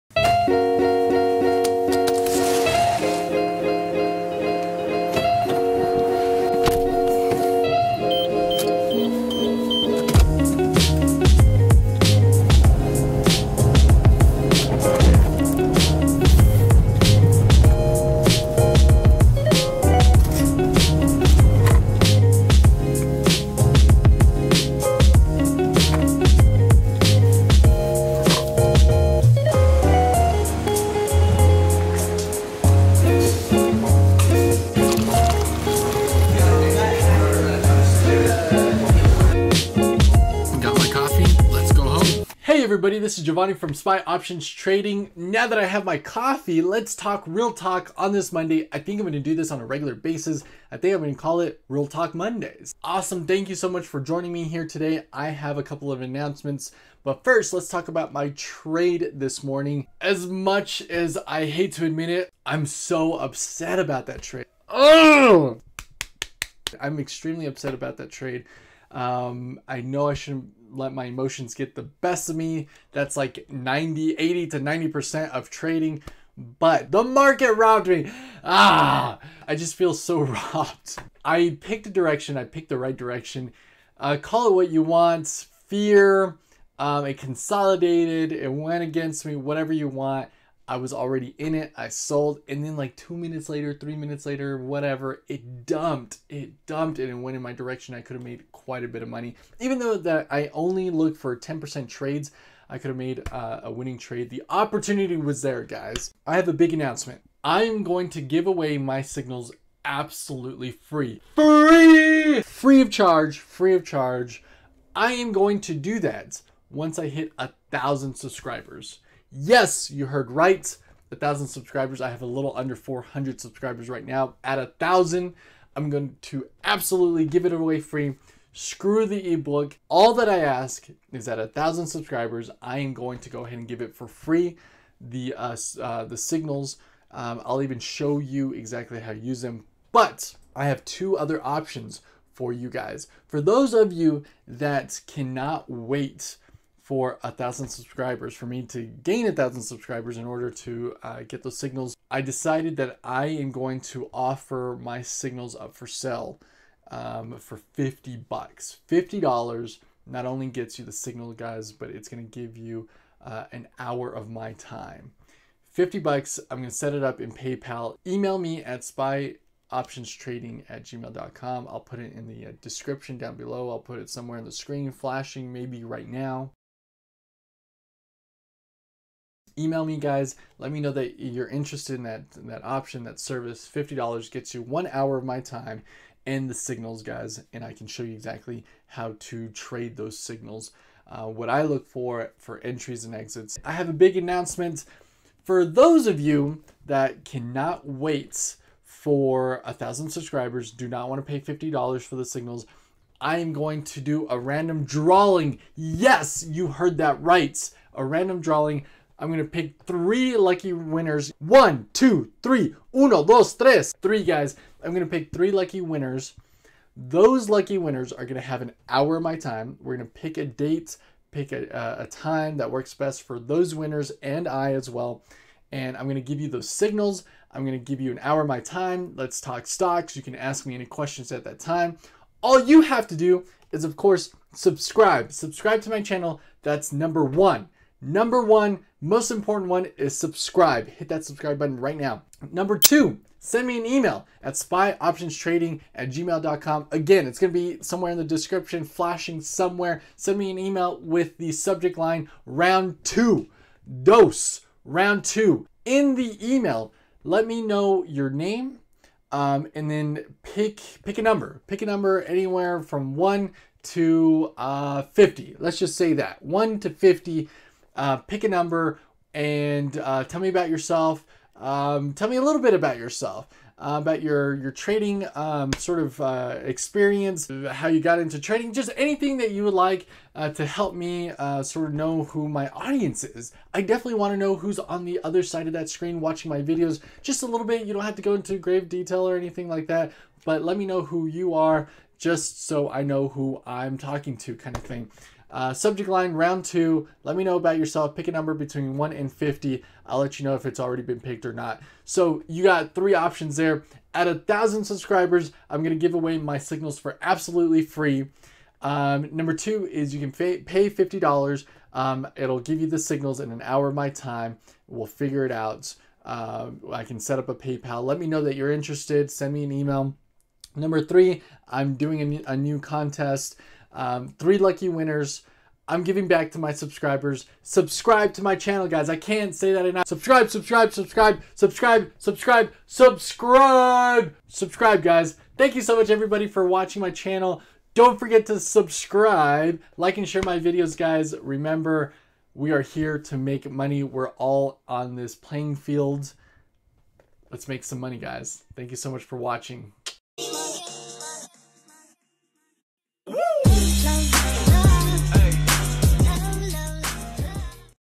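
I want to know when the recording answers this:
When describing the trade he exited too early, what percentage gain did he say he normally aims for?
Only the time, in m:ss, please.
1:41.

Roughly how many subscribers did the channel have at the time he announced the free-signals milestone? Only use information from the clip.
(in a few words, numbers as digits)
400.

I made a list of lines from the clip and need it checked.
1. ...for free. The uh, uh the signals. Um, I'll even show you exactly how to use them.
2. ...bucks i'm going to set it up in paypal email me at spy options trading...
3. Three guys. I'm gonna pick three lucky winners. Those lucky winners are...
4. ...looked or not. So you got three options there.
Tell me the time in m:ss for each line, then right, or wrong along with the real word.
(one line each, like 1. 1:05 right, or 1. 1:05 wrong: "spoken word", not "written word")
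1. 2:13 right
2. 2:45 right
3. 3:34 right
4. 5:01 wrong: "picked", not "looked".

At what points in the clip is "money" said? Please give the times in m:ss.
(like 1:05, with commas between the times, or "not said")
1:39, 5:43, 5:47.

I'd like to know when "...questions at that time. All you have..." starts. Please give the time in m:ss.
3:50.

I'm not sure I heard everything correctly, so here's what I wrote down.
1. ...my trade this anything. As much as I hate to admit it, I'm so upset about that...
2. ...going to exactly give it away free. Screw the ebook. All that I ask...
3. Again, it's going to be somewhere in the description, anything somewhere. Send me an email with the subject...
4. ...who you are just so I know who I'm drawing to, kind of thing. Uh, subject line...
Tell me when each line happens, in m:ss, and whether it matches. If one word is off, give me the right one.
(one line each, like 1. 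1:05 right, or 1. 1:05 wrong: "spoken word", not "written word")
1. 0:58 wrong: "morning", not "anything"
2. 2:05 wrong: "absolutely", not "exactly"
3. 4:06 wrong: "flashing", not "anything"
4. 4:51 wrong: "talking", not "drawing".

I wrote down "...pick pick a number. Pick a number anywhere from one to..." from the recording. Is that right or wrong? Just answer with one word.
right.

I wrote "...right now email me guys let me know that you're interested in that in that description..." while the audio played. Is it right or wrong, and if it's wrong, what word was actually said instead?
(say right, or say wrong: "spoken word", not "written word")
wrong: "option", not "description".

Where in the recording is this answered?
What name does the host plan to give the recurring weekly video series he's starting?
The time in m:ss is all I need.
0:51.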